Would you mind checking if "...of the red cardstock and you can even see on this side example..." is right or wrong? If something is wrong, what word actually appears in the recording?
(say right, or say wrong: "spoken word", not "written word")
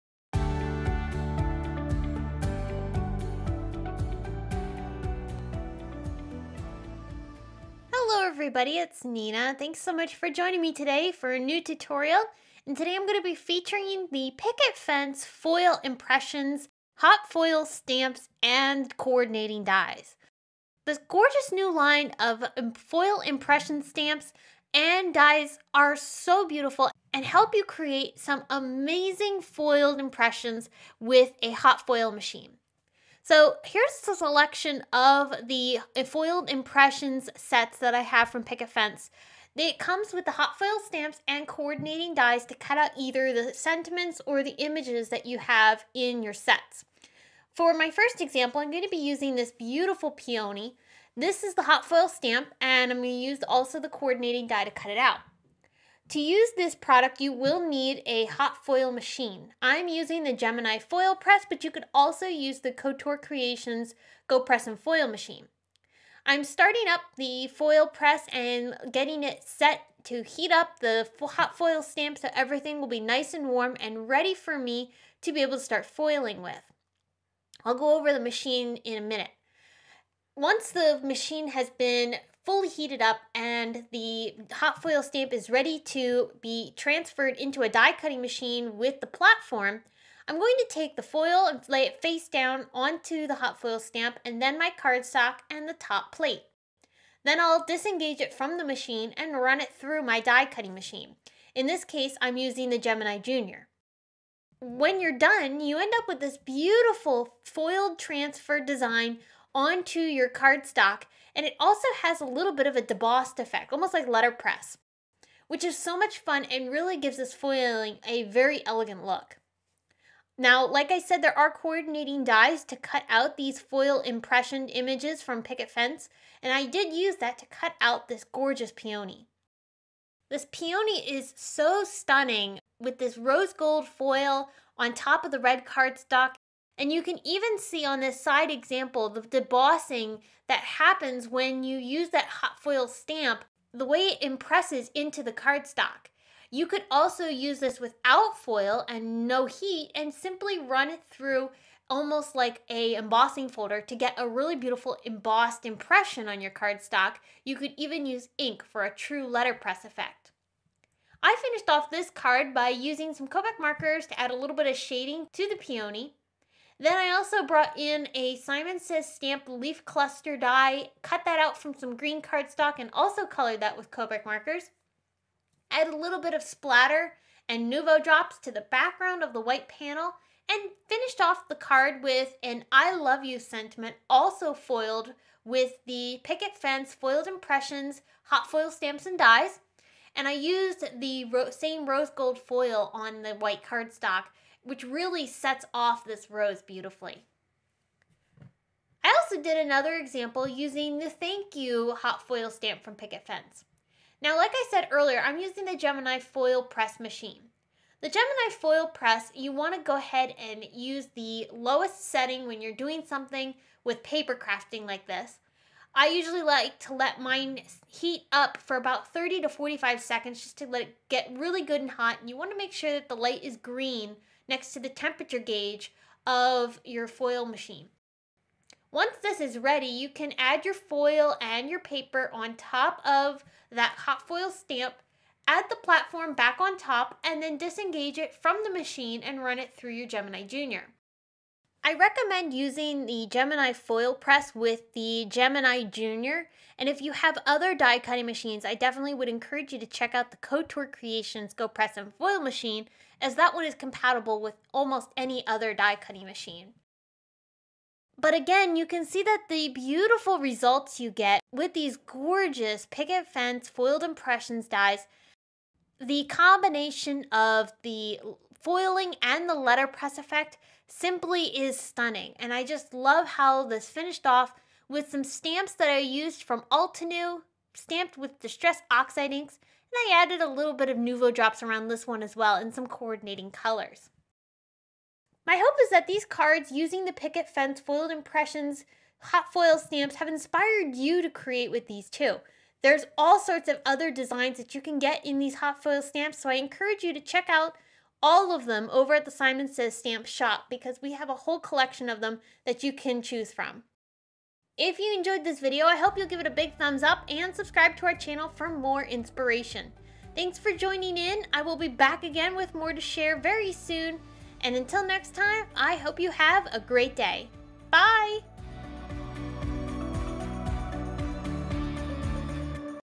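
right.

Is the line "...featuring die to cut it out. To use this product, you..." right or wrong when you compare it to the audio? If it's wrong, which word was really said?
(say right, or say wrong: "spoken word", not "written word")
wrong: "coordinating", not "featuring".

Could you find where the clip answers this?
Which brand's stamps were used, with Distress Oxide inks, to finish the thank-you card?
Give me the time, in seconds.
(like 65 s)
276 s.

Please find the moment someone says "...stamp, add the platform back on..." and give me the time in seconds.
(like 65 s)
234 s.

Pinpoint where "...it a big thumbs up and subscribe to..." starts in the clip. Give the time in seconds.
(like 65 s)
306 s.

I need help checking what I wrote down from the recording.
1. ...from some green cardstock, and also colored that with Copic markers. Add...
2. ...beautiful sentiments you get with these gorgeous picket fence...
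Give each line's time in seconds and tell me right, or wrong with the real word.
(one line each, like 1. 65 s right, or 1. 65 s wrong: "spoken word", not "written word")
1. 171 s right
2. 259 s wrong: "results", not "sentiments".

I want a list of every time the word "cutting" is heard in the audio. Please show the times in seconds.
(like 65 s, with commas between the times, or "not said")
87 s, 100 s, 247 s, 255 s.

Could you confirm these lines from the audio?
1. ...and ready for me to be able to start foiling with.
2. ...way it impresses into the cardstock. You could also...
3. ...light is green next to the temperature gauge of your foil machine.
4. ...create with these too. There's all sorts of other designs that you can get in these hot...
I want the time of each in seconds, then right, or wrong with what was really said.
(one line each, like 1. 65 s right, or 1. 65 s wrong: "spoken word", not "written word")
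1. 73 s right
2. 143 s right
3. 223 s right
4. 291 s right.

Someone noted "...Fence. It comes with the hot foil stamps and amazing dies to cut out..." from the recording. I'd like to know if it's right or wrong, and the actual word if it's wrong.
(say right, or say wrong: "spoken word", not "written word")
wrong: "coordinating", not "amazing".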